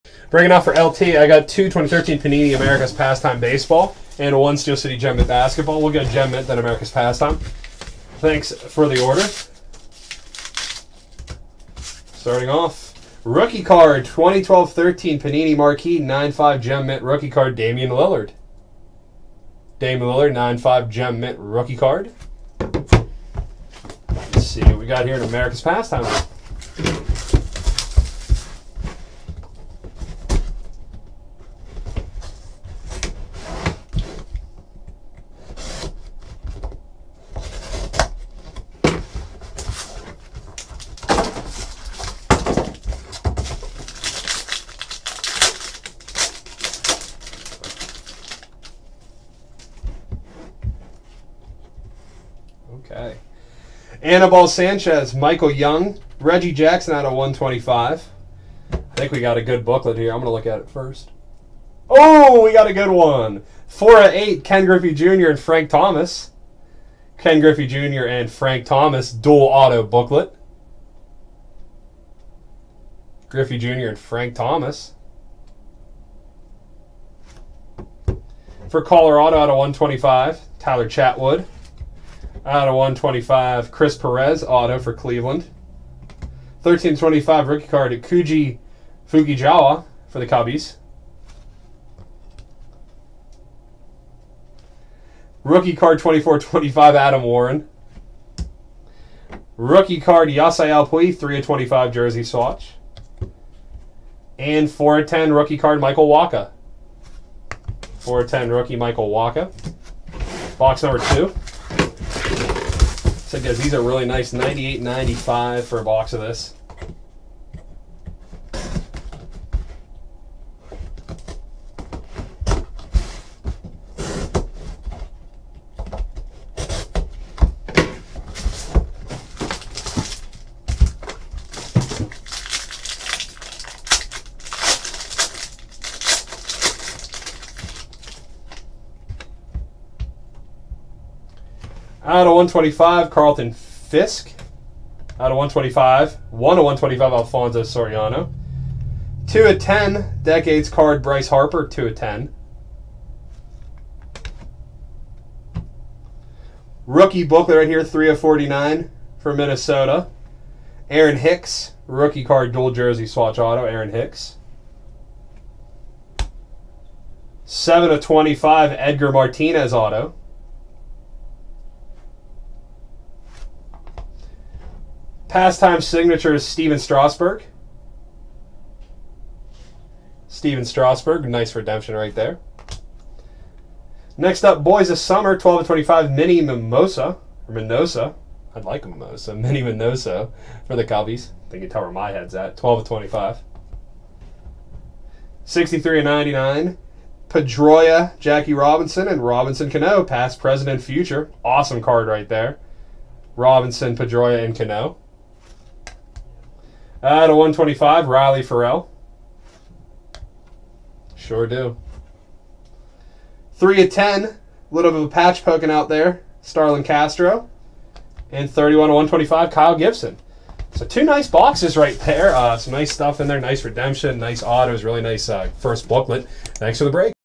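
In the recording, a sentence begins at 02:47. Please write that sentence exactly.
7 of 25, Edgar Martinez auto.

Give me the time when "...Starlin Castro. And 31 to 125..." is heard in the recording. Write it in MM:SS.
03:36.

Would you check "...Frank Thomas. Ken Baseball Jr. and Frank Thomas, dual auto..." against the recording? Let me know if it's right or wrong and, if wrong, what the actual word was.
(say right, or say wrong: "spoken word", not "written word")
wrong: "Griffey", not "Baseball".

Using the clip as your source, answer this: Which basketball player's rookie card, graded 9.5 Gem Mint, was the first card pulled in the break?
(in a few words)
Damian Lillard.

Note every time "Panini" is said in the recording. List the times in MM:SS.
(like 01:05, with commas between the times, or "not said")
00:02, 00:15.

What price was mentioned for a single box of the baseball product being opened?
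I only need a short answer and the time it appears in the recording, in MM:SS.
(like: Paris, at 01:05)
98.95, at 01:54.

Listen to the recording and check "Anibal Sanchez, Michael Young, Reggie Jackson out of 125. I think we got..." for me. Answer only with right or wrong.
right.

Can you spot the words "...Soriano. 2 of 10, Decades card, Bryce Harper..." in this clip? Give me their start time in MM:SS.
02:27.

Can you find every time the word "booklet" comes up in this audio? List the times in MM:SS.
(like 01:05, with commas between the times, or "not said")
00:59, 01:09, 02:37, 03:45.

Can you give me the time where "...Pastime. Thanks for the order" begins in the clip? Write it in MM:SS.
00:06.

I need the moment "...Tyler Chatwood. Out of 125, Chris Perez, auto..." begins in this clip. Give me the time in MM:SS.
01:20.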